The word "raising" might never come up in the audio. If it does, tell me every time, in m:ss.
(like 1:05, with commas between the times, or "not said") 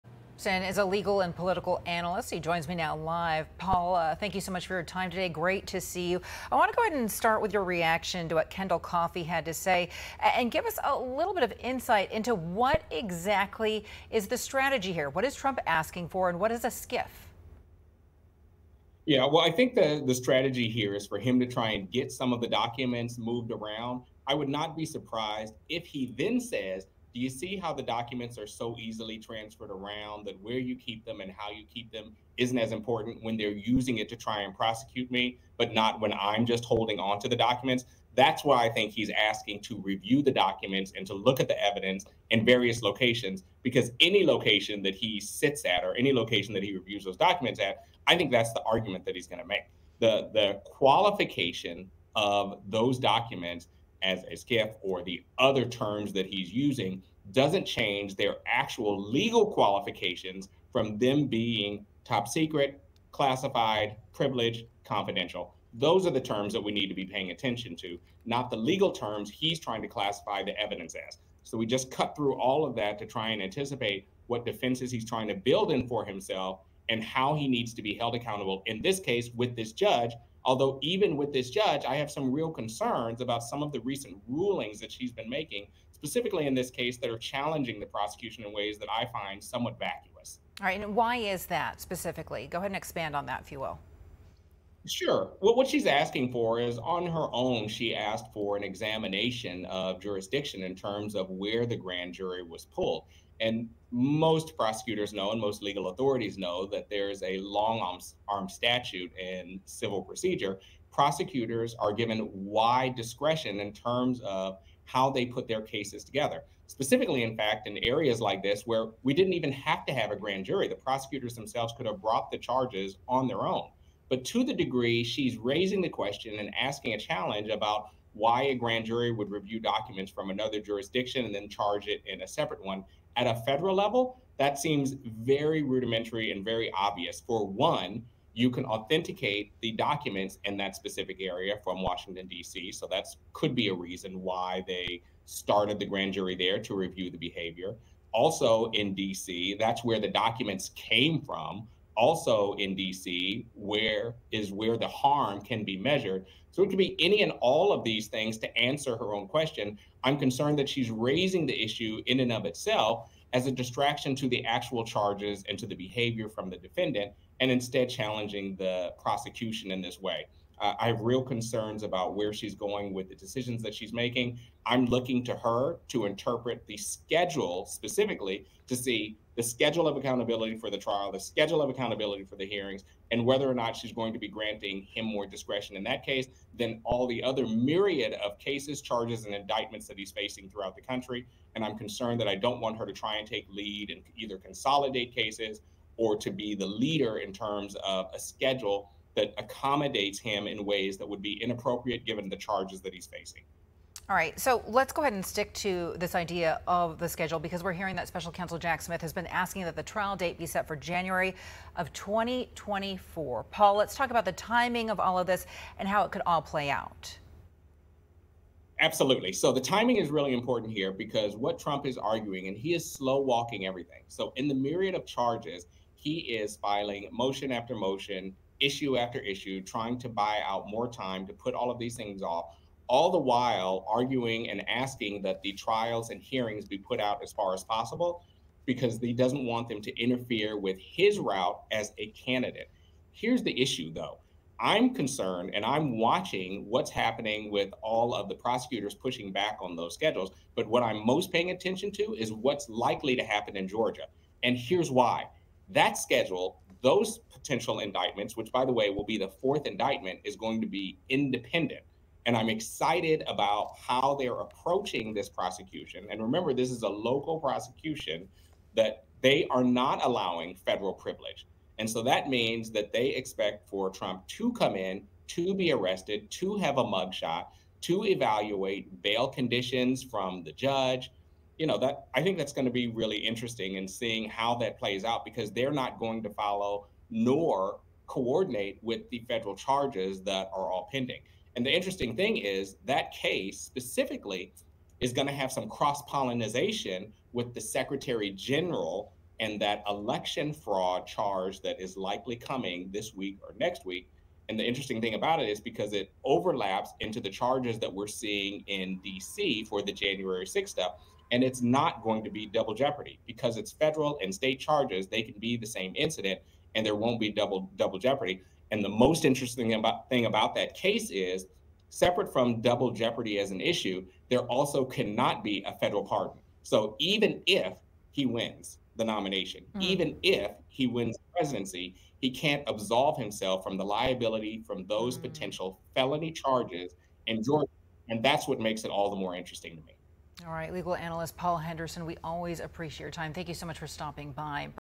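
2:05, 2:40.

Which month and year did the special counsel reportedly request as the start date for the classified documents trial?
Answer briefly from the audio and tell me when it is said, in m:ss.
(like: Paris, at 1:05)
January 2024, at 3:30.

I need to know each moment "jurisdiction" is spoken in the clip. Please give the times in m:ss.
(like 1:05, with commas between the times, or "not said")
1:40, 2:10.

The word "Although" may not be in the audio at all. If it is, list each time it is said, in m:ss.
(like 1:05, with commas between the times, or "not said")
1:20.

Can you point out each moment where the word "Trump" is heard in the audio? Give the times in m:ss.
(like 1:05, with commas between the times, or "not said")
0:15, 3:41, 4:33.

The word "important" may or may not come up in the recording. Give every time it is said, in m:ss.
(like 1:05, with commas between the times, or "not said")
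0:32, 3:40.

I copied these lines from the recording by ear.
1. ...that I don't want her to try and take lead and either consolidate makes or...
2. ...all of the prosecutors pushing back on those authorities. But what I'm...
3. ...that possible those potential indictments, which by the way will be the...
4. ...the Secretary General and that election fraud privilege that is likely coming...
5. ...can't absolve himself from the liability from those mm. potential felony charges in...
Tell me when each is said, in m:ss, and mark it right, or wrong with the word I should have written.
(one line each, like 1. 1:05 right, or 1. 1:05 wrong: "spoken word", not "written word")
1. 3:12 wrong: "cases", not "makes"
2. 4:07 wrong: "schedules", not "authorities"
3. 4:15 wrong: "schedule", not "possible"
4. 4:57 wrong: "charge", not "privilege"
5. 5:32 right.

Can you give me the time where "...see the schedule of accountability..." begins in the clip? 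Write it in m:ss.
2:58.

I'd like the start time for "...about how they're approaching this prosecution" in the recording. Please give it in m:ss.
4:23.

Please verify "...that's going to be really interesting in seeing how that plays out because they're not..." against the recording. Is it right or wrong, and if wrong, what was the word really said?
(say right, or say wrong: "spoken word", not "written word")
right.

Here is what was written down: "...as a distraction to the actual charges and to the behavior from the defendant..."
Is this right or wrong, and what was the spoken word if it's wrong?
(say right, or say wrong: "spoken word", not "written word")
right.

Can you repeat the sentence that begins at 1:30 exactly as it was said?
All right, and why is that specifically?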